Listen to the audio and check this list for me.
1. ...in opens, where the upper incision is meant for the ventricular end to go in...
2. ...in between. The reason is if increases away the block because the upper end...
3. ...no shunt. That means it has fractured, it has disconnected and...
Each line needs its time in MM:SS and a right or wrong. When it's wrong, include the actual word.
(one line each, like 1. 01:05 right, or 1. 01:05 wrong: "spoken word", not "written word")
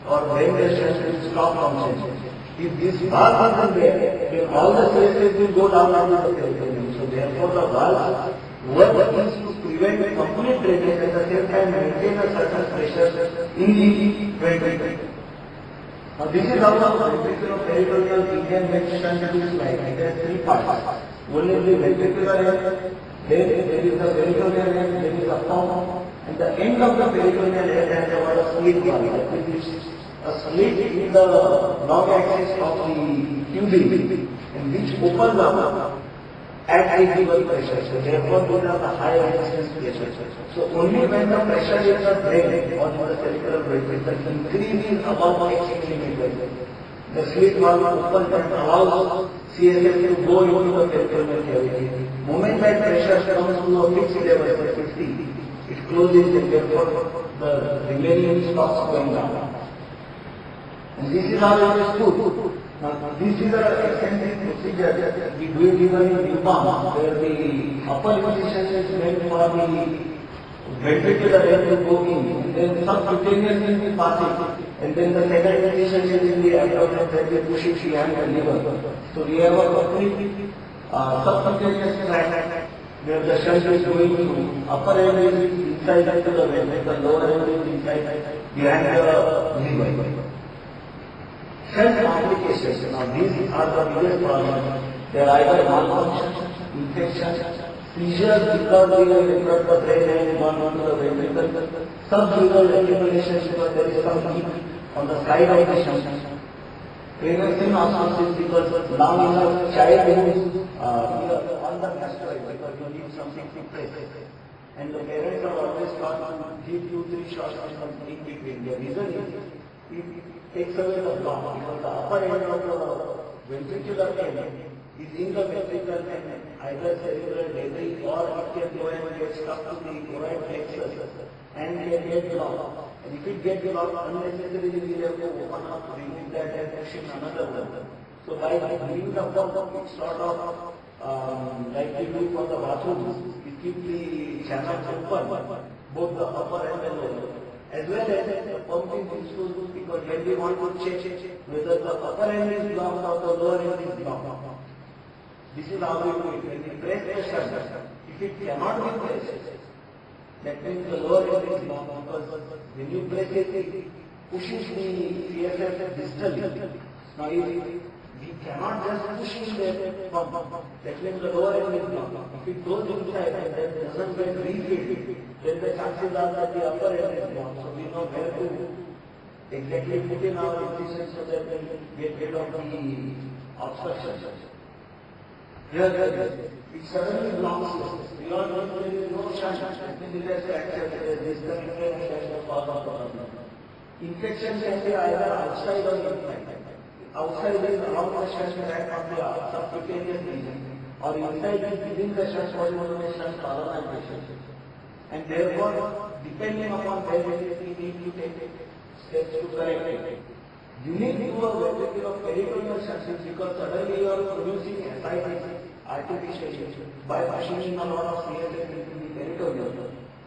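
1. 01:06 wrong: "newborns", not "opens"
2. 01:58 wrong: "takes", not "increases"
3. 03:09 right.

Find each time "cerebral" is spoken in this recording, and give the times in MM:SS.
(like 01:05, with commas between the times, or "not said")
00:43, 02:07.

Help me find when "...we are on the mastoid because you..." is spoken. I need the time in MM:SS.
01:51.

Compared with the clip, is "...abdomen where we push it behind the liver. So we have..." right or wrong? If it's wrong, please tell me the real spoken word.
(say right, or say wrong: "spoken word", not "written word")
right.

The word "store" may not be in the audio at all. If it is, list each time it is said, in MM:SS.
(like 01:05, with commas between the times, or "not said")
not said.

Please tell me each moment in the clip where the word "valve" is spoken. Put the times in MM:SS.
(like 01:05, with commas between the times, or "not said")
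00:03, 00:07, 00:28, 00:47.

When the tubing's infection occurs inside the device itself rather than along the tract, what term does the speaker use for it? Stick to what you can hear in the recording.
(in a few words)
shunt colonization.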